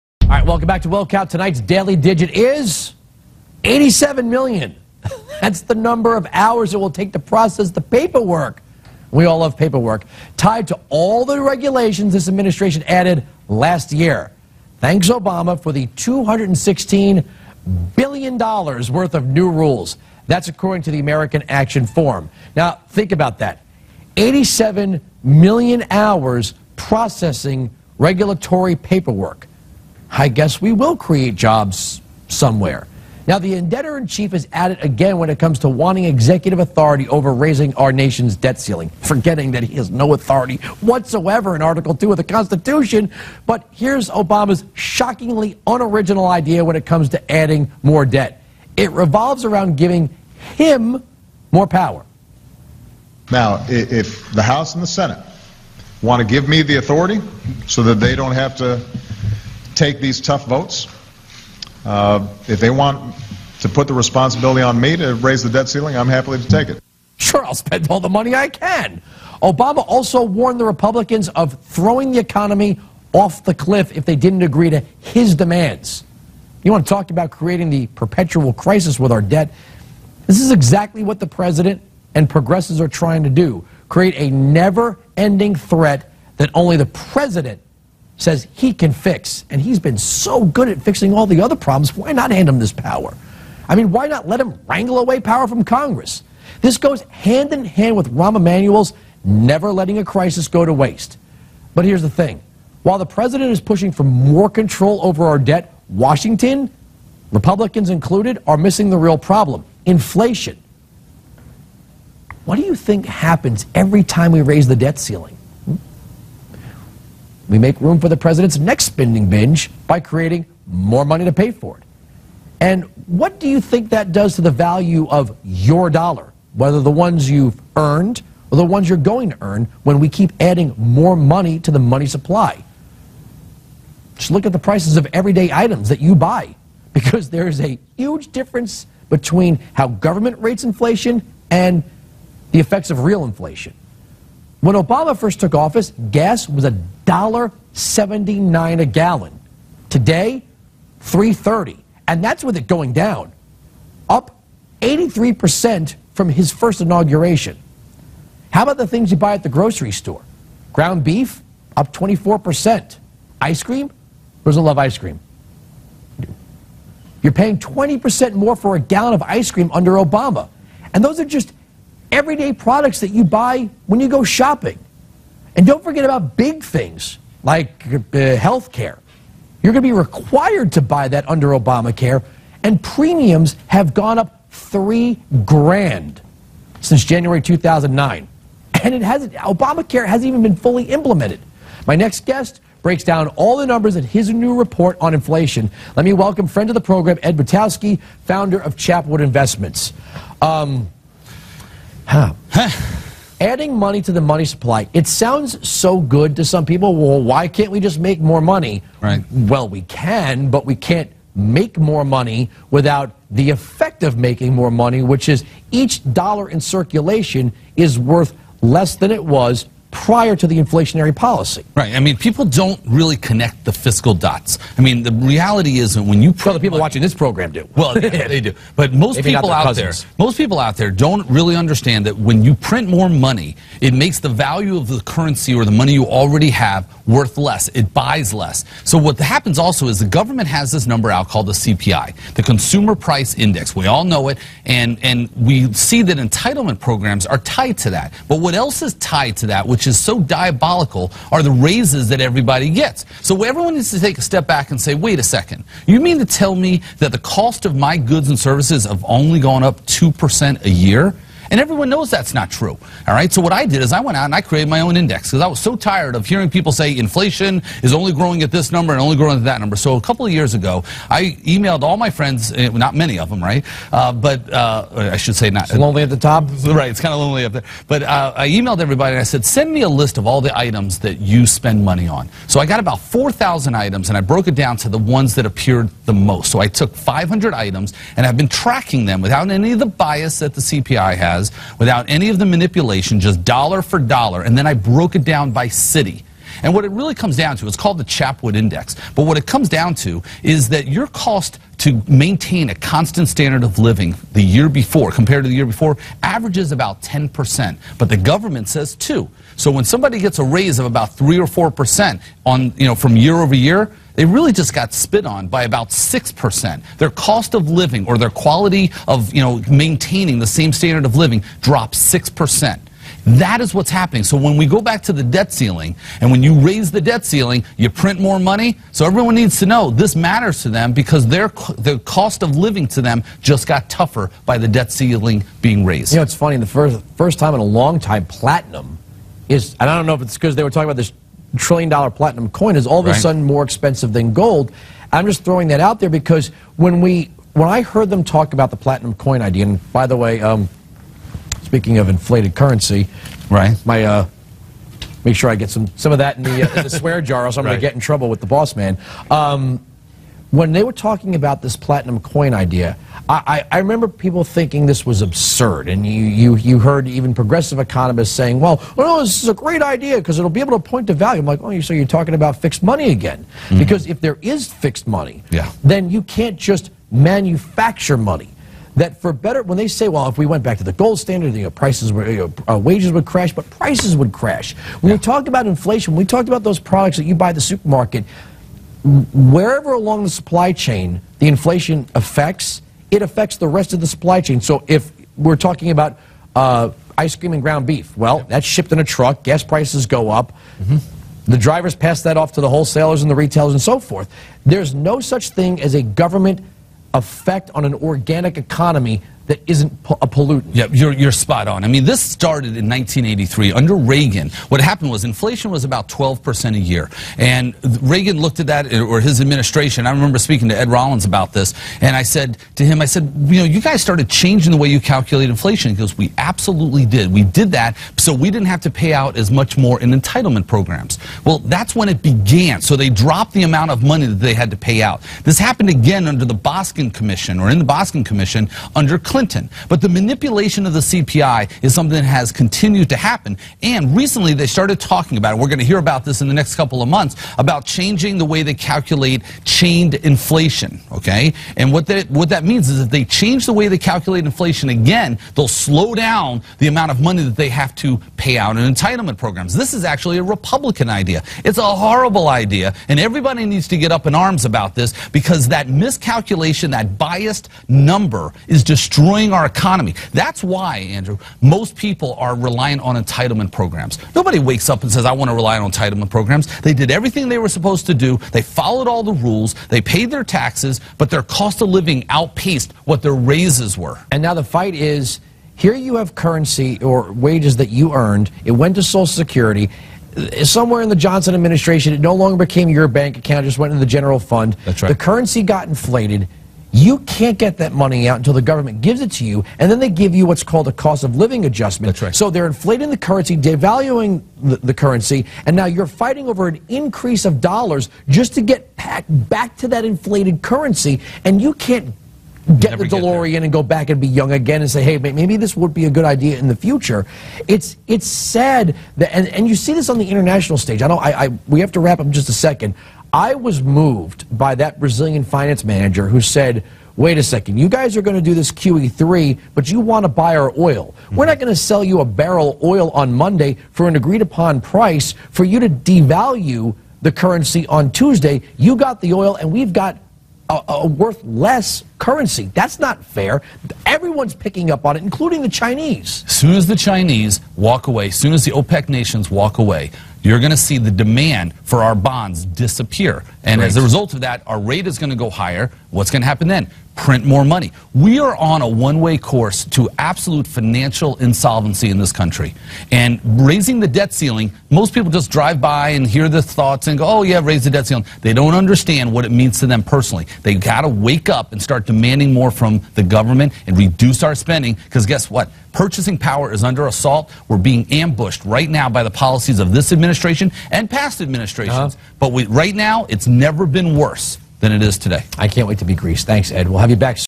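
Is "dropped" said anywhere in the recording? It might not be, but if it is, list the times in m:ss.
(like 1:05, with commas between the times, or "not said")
5:21, 7:13.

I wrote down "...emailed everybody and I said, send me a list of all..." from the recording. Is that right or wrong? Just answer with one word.
right.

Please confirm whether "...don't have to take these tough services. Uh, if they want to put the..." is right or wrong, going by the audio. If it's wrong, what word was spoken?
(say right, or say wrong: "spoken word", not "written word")
wrong: "votes", not "services".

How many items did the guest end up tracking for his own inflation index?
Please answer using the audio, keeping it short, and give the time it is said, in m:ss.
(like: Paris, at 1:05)
500, at 4:46.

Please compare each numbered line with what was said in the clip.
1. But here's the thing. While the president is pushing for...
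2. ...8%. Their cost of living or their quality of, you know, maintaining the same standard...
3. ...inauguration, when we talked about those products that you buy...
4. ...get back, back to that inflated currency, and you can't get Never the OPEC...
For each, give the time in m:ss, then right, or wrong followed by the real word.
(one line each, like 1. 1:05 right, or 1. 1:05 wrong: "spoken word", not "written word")
1. 1:41 right
2. 5:15 wrong: "6", not "8"
3. 6:25 wrong: "inflation", not "inauguration"
4. 8:28 wrong: "DeLorean", not "OPEC".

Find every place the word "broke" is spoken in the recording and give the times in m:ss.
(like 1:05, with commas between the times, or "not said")
4:44, 4:54.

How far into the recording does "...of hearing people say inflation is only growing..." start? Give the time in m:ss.
4:26.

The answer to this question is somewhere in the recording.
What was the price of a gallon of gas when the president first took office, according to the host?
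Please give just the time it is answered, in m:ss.
2:26.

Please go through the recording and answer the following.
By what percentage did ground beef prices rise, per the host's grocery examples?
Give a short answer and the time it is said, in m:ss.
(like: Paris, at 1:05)
24%, at 2:41.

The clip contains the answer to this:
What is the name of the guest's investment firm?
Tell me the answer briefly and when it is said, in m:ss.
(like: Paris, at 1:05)
Chapwood Investments, at 3:18.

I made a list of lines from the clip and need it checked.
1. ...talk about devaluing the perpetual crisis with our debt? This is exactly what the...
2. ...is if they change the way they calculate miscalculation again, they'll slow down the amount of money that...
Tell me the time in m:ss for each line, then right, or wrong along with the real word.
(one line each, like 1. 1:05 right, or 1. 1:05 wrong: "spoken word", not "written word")
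1. 1:16 wrong: "creating", not "devaluing"
2. 7:32 wrong: "inflation", not "miscalculation".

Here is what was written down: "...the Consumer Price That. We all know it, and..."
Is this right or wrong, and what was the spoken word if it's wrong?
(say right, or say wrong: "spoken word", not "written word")
wrong: "Index", not "That".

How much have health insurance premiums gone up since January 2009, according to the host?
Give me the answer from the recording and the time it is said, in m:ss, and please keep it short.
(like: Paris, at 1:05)
3 grand, at 3:04.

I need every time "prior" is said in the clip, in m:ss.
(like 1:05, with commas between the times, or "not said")
3:39.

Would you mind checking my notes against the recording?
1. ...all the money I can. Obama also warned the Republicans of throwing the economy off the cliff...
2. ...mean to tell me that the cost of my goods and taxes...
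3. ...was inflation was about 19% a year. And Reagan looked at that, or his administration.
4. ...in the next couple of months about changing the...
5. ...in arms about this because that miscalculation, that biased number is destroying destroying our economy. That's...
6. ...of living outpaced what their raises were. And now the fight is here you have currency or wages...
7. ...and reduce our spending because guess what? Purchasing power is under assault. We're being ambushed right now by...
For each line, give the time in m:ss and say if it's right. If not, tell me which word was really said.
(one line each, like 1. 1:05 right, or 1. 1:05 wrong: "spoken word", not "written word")
1. 1:07 right
2. 4:15 wrong: "services", not "taxes"
3. 6:55 wrong: "12", not "19"
4. 7:26 right
5. 7:44 right
6. 8:01 right
7. 9:33 right.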